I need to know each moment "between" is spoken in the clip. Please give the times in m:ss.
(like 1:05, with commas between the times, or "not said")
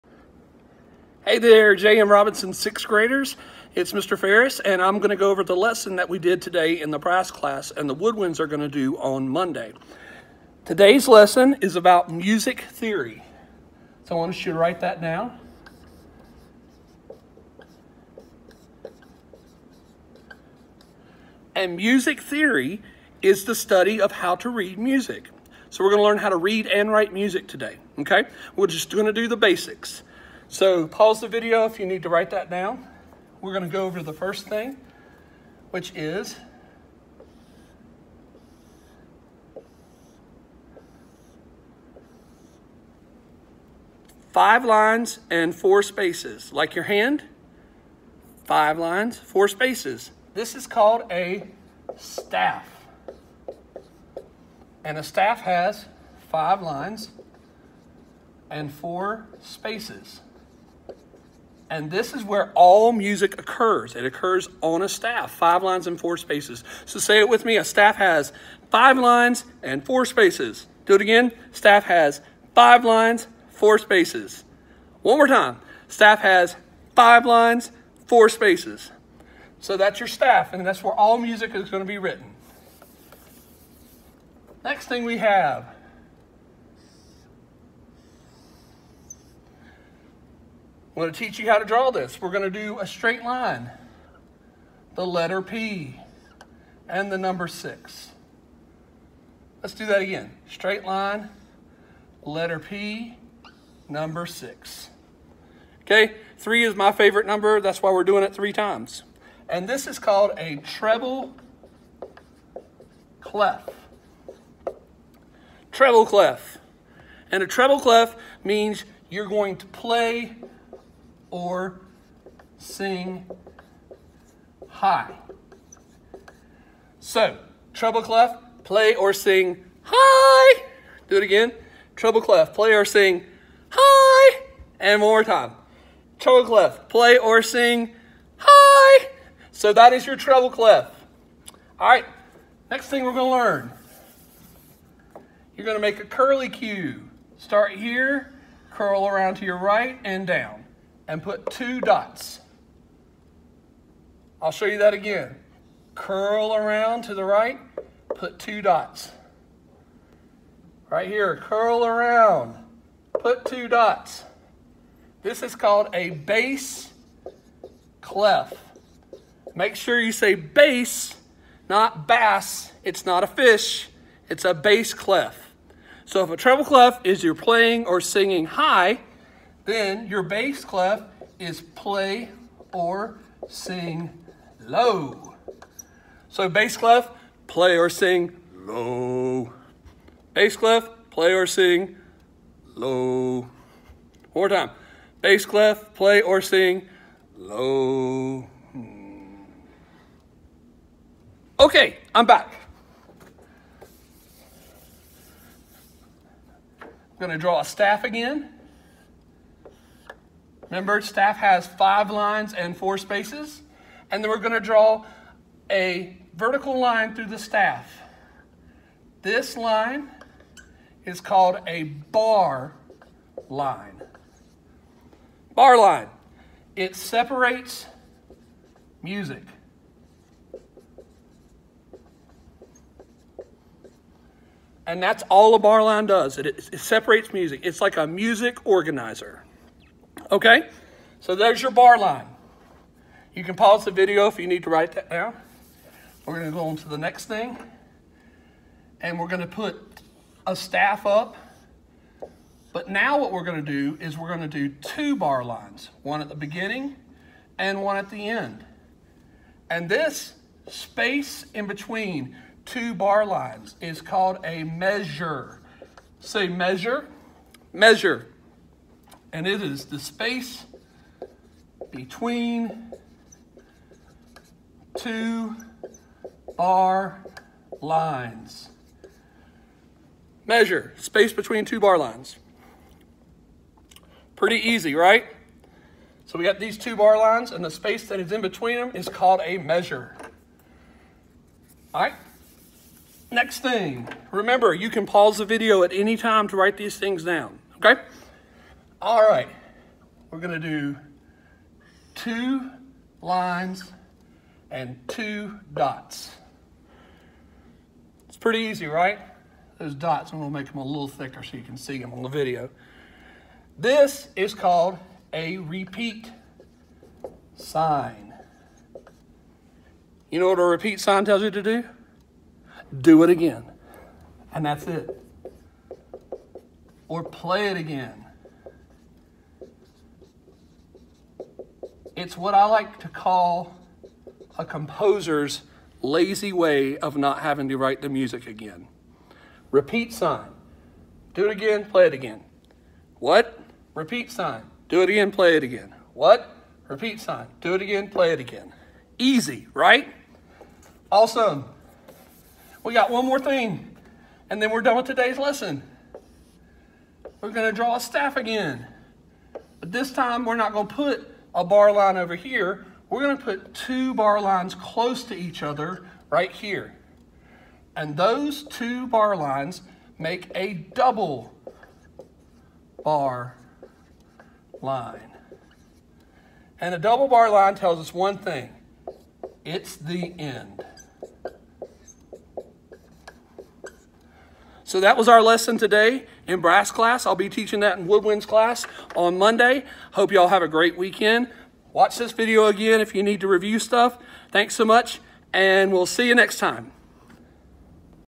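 4:21, 4:31, 4:41, 4:48.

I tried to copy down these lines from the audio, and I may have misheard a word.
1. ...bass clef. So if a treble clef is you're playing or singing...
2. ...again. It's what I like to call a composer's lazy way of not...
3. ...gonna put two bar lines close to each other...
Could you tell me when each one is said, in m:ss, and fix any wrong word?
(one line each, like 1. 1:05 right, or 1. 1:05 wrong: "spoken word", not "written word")
1. 2:54 right
2. 5:27 right
3. 6:03 right.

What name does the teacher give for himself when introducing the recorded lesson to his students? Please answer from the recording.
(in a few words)
Mr. Faires.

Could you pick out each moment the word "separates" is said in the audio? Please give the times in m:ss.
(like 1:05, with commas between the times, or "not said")
3:46, 3:56.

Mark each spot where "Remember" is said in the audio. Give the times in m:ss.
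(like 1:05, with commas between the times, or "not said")
3:30, 4:54.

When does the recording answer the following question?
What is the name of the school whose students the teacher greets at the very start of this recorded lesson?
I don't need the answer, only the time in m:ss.
0:01.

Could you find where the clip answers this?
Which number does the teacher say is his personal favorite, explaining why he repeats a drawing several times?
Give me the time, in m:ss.
1:46.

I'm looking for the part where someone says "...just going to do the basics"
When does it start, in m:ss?
0:28.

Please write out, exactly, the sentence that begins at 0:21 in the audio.
And music theory is the study of how to read music.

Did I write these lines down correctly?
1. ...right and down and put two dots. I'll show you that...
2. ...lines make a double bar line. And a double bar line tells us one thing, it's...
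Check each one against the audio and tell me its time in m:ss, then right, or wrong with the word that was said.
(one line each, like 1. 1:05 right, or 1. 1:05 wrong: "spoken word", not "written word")
1. 2:29 right
2. 6:09 right.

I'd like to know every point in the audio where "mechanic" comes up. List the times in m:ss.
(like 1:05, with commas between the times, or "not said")
not said.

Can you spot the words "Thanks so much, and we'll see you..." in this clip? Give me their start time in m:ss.
6:34.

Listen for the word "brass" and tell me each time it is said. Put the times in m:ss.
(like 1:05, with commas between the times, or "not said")
0:06, 6:26.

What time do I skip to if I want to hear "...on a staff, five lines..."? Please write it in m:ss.
1:04.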